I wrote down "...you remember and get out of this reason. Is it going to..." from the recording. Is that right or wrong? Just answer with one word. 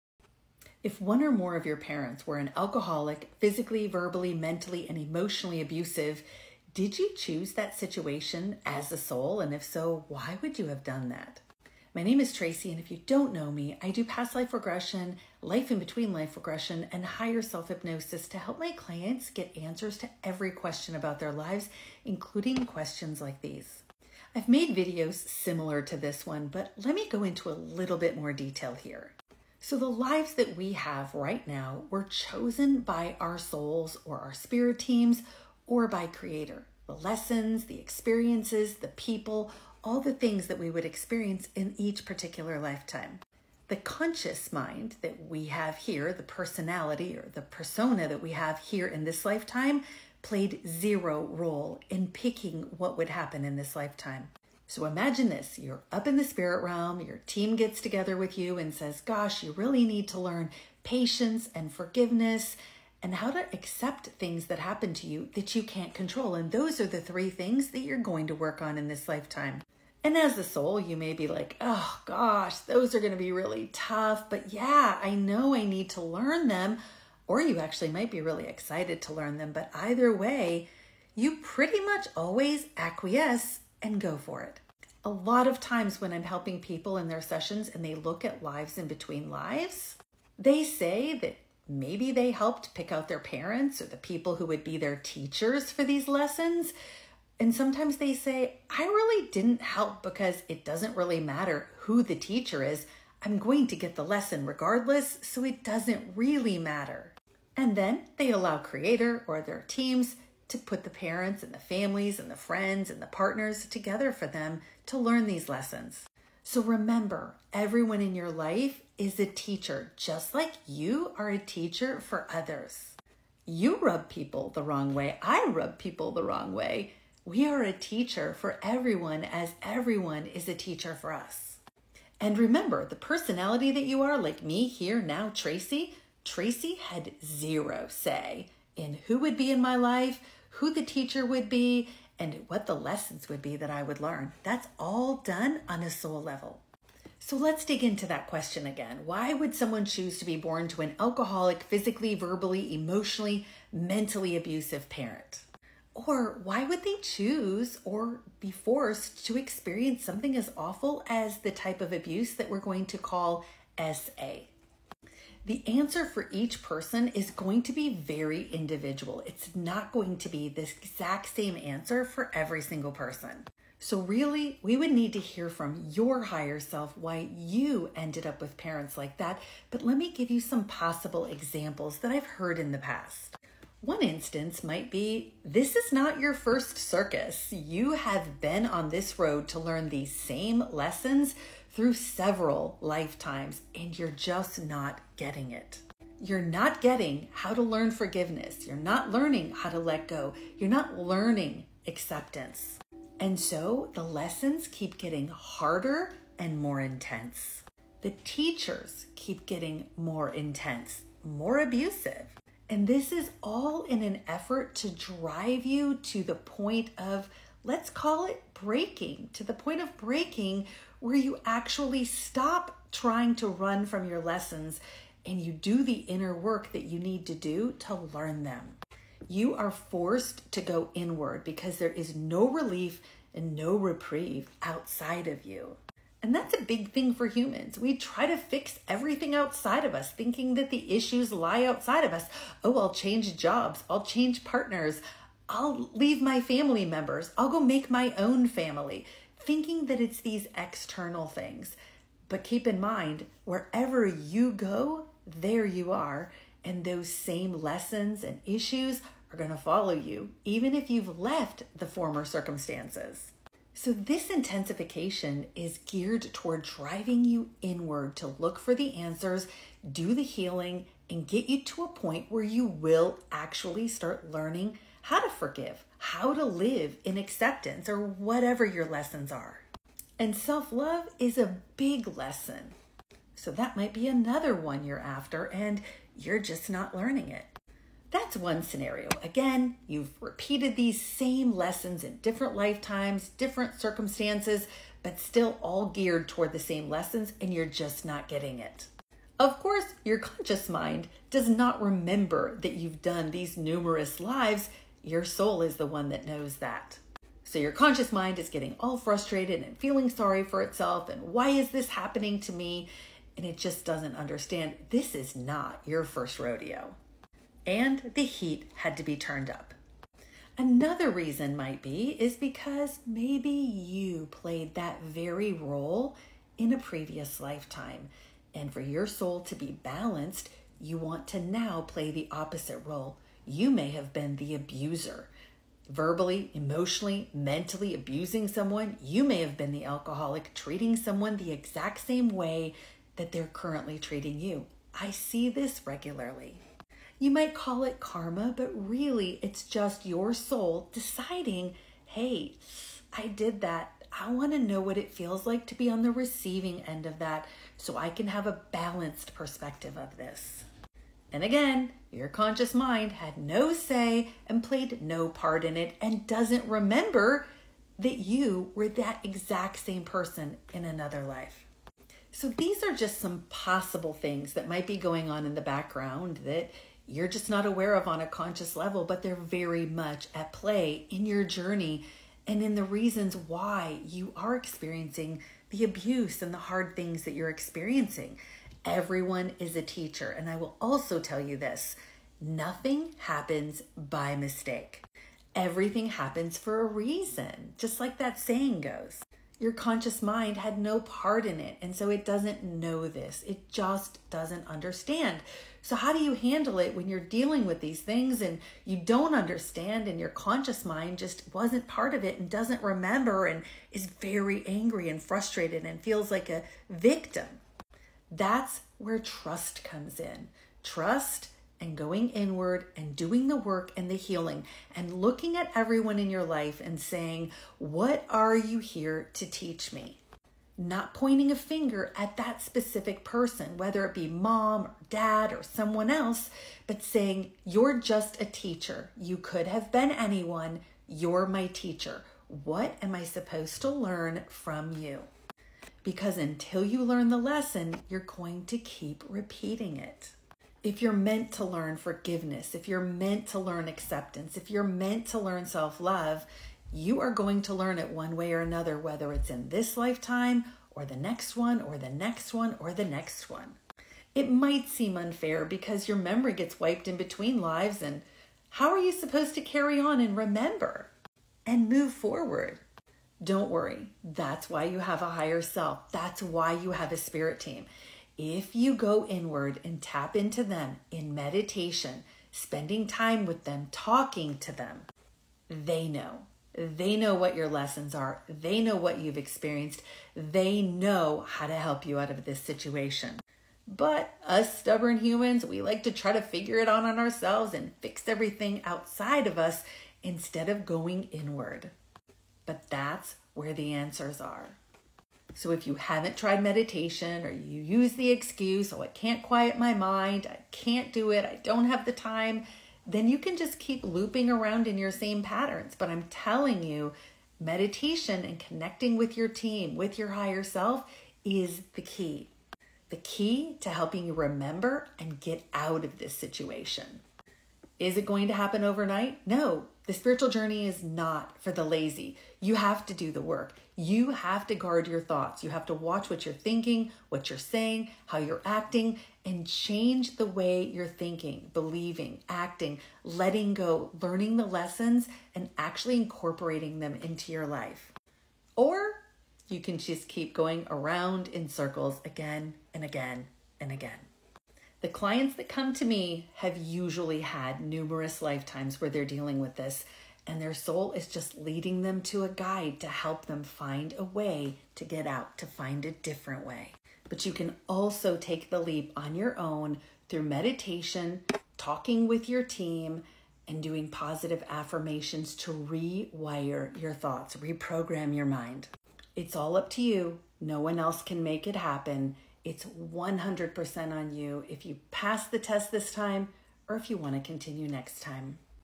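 wrong.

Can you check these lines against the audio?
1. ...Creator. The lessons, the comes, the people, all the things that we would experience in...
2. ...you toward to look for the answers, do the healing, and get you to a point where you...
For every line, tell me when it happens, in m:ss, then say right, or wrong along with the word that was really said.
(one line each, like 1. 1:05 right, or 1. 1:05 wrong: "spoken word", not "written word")
1. 0:36 wrong: "experiences", not "comes"
2. 4:27 wrong: "inward", not "toward".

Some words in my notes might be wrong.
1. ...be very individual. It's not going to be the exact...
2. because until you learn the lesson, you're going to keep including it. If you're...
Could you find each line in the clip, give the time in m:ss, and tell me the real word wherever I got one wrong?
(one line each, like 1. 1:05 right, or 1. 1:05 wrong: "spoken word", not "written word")
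1. 2:47 right
2. 7:26 wrong: "repeating", not "including".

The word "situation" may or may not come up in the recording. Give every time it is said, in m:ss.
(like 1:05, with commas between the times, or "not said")
0:07, 8:12, 8:46.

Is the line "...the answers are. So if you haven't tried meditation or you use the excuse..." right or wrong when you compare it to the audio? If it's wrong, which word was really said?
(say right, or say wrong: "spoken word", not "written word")
right.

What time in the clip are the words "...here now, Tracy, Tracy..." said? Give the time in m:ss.
2:14.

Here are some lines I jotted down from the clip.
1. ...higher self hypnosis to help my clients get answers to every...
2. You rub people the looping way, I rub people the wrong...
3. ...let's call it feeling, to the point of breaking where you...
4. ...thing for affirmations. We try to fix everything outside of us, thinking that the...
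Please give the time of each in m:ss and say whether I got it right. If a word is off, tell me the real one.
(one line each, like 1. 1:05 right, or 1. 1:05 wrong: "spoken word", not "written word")
1. 0:17 right
2. 2:03 wrong: "wrong", not "looping"
3. 3:37 wrong: "breaking", not "feeling"
4. 3:56 wrong: "humans", not "affirmations".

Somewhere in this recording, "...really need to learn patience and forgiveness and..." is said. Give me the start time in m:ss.
0:59.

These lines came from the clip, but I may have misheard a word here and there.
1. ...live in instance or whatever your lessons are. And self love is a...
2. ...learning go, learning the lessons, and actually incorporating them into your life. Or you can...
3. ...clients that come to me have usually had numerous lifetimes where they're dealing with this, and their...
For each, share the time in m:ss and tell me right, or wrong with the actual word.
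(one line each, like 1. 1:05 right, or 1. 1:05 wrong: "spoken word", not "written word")
1. 4:36 wrong: "acceptance", not "instance"
2. 9:03 wrong: "letting", not "learning"
3. 9:15 right.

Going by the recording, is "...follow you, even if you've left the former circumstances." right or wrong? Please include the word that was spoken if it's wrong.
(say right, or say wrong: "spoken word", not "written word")
right.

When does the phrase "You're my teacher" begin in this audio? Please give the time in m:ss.
7:21.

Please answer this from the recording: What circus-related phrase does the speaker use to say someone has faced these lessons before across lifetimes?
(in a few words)
not your first circus.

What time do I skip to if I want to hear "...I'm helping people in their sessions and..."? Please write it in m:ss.
1:26.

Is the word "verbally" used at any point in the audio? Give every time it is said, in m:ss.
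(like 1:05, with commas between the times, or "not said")
0:03, 2:32, 5:35.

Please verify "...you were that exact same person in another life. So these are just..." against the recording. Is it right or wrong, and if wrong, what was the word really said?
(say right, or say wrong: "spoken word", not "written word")
right.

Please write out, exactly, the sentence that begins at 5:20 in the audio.
Another reason might be is because maybe you played that very role in a previous lifetime.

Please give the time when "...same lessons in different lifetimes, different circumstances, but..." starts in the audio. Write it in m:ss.
4:50.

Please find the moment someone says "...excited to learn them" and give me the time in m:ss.
1:18.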